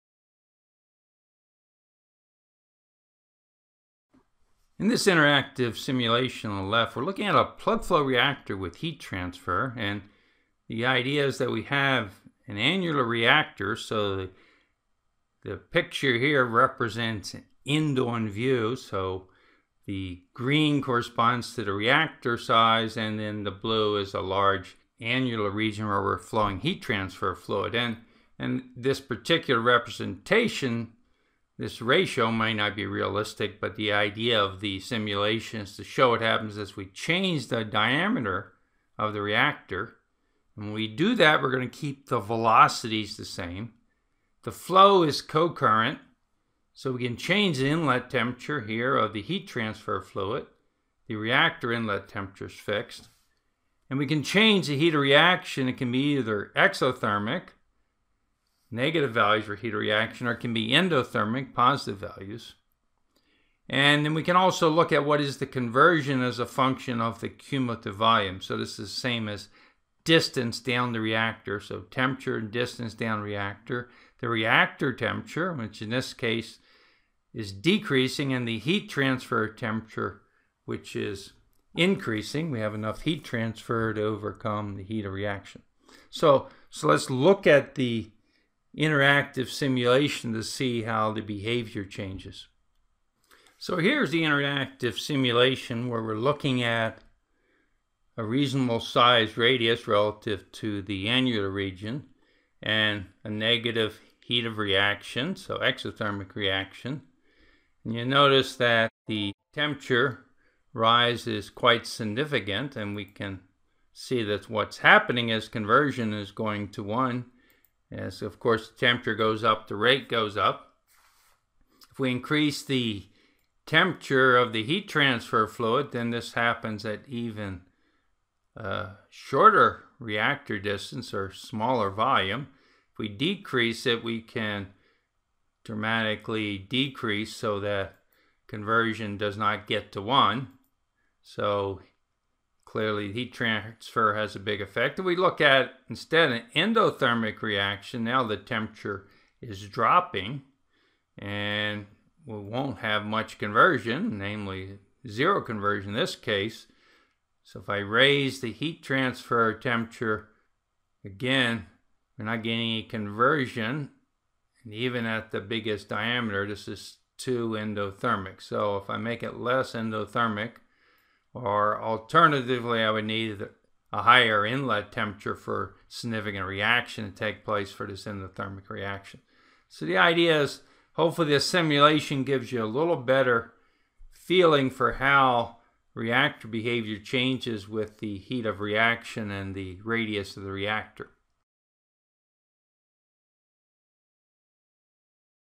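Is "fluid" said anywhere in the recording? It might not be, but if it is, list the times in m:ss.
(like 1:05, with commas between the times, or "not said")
0:27, 0:50, 2:05.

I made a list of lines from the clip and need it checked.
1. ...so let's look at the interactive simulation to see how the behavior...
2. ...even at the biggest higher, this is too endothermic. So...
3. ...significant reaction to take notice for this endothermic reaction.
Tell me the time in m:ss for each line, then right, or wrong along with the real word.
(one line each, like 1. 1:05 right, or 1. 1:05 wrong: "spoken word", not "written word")
1. 1:26 right
2. 2:44 wrong: "diameter", not "higher"
3. 2:55 wrong: "place", not "notice".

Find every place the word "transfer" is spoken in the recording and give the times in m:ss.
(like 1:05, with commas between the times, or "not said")
0:08, 0:26, 0:49, 1:18, 1:23, 2:04, 2:23, 2:38.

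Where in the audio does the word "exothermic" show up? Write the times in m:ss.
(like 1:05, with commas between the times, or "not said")
0:56, 1:45.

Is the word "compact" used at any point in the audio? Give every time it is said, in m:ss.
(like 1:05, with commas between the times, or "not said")
not said.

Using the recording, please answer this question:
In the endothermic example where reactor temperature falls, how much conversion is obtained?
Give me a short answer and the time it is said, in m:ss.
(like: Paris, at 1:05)
Zero, at 2:35.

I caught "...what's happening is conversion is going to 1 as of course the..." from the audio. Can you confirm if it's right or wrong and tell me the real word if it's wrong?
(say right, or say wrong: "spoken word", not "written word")
right.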